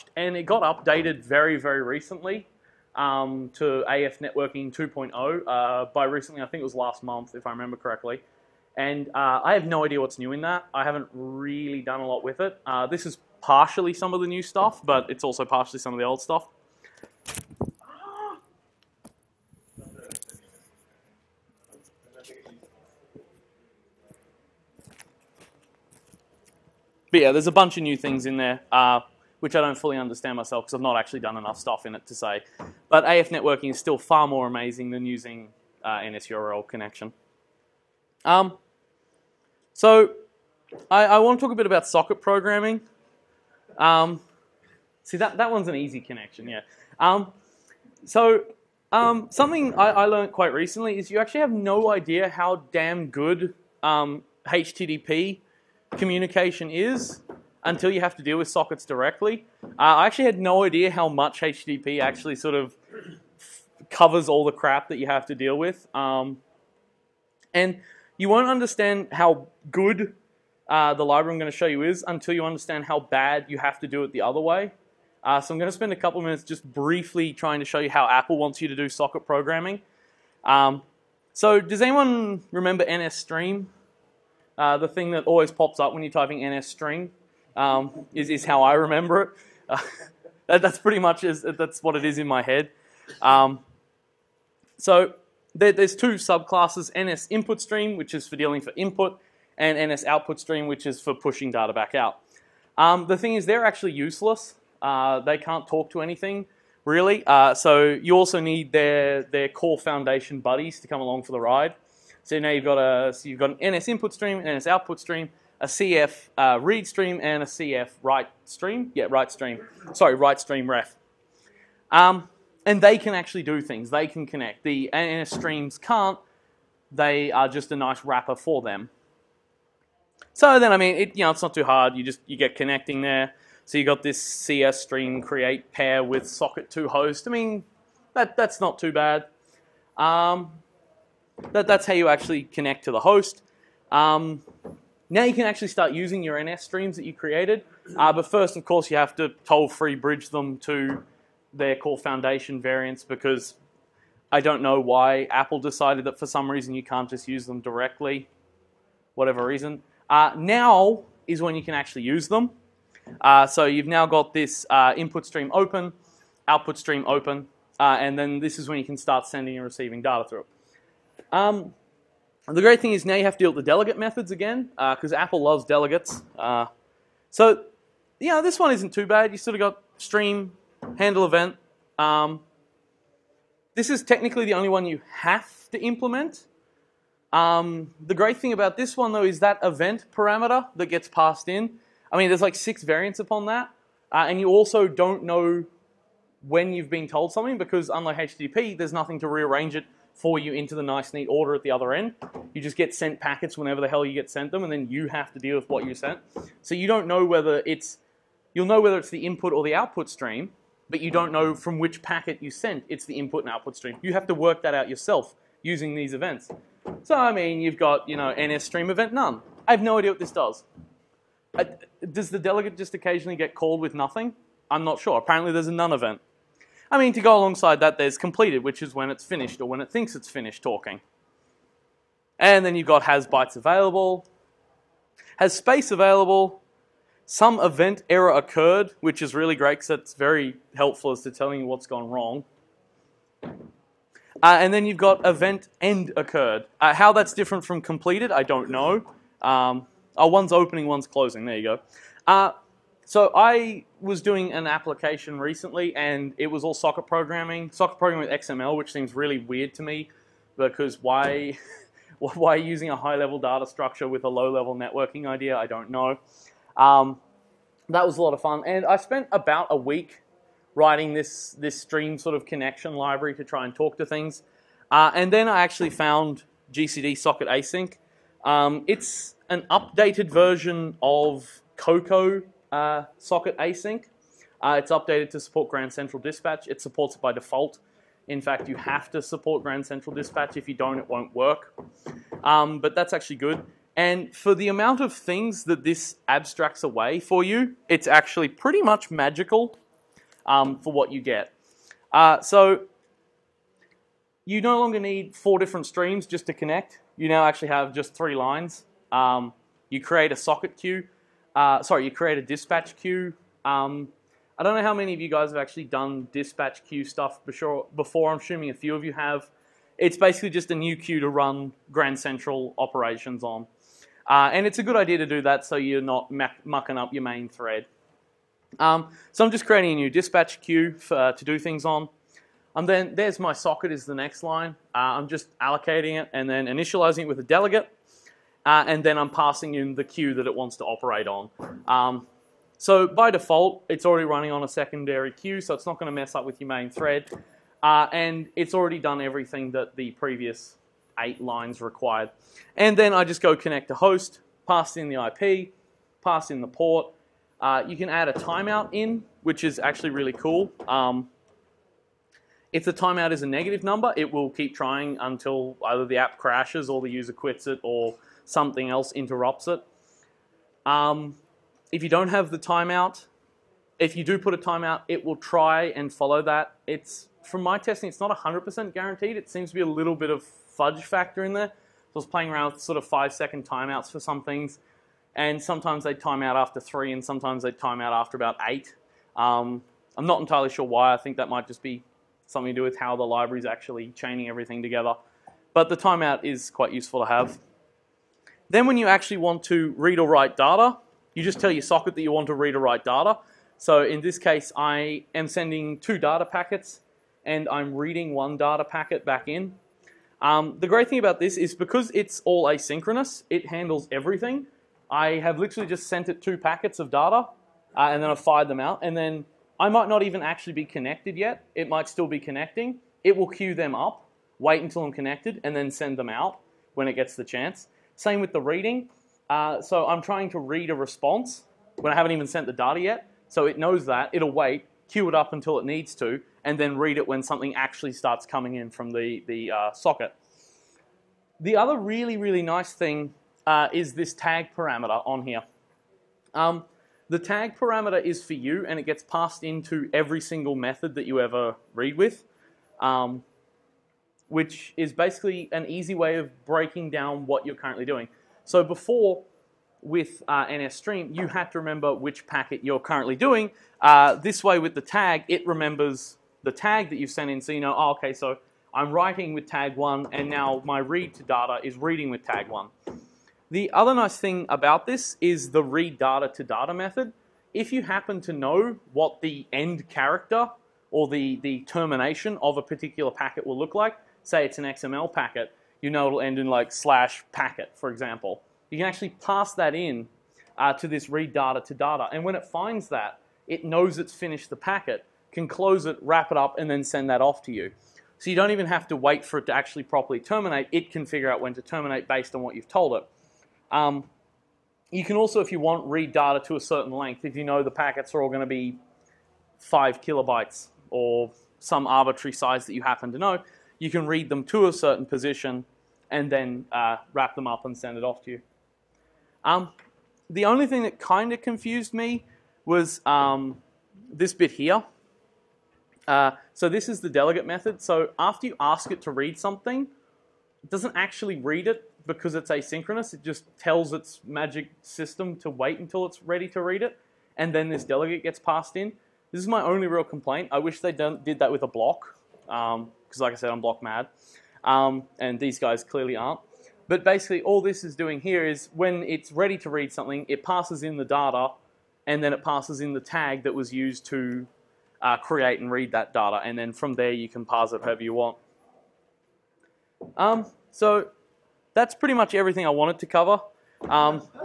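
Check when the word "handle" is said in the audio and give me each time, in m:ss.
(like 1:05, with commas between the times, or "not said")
3:00, 6:53.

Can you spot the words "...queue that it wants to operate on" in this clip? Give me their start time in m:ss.
5:40.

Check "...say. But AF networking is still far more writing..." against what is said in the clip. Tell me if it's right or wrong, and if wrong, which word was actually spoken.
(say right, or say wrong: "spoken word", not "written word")
wrong: "amazing", not "writing".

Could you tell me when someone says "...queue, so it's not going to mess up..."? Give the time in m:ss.
5:45.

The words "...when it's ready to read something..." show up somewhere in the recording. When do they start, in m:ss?
9:08.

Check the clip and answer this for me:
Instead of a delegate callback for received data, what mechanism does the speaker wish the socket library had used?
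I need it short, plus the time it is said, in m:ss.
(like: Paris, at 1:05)
a block, at 9:01.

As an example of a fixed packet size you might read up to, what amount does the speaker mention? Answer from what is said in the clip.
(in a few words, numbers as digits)
5 kilobytes.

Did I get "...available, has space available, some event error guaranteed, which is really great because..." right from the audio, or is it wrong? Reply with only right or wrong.
wrong.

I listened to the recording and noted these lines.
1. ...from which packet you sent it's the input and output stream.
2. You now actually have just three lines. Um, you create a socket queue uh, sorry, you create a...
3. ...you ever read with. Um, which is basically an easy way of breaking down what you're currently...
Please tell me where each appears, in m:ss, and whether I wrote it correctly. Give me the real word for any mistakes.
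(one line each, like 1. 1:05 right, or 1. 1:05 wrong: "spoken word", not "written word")
1. 3:31 right
2. 5:07 right
3. 7:31 right.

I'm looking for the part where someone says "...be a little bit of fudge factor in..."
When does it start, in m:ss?
6:19.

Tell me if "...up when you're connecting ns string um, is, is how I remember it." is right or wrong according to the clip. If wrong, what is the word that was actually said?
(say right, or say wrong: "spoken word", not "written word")
wrong: "typing", not "connecting".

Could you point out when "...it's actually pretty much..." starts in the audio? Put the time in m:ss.
4:57.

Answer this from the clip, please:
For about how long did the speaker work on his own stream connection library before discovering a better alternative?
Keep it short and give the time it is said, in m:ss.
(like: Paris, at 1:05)
a week, at 4:29.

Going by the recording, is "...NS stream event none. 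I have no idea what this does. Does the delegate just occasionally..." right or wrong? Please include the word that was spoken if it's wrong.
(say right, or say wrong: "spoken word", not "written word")
right.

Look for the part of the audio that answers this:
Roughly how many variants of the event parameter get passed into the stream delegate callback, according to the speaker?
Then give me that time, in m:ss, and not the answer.
3:12.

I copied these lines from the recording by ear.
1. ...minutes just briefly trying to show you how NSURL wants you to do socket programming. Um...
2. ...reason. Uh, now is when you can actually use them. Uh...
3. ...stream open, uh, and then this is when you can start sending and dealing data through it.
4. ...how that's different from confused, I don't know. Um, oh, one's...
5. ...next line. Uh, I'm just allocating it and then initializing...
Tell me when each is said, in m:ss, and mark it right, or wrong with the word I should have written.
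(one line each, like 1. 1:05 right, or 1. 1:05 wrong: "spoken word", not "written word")
1. 1:16 wrong: "Apple", not "NSURL"
2. 2:39 right
3. 2:46 wrong: "receiving", not "dealing"
4. 4:06 wrong: "completed", not "confused"
5. 5:34 right.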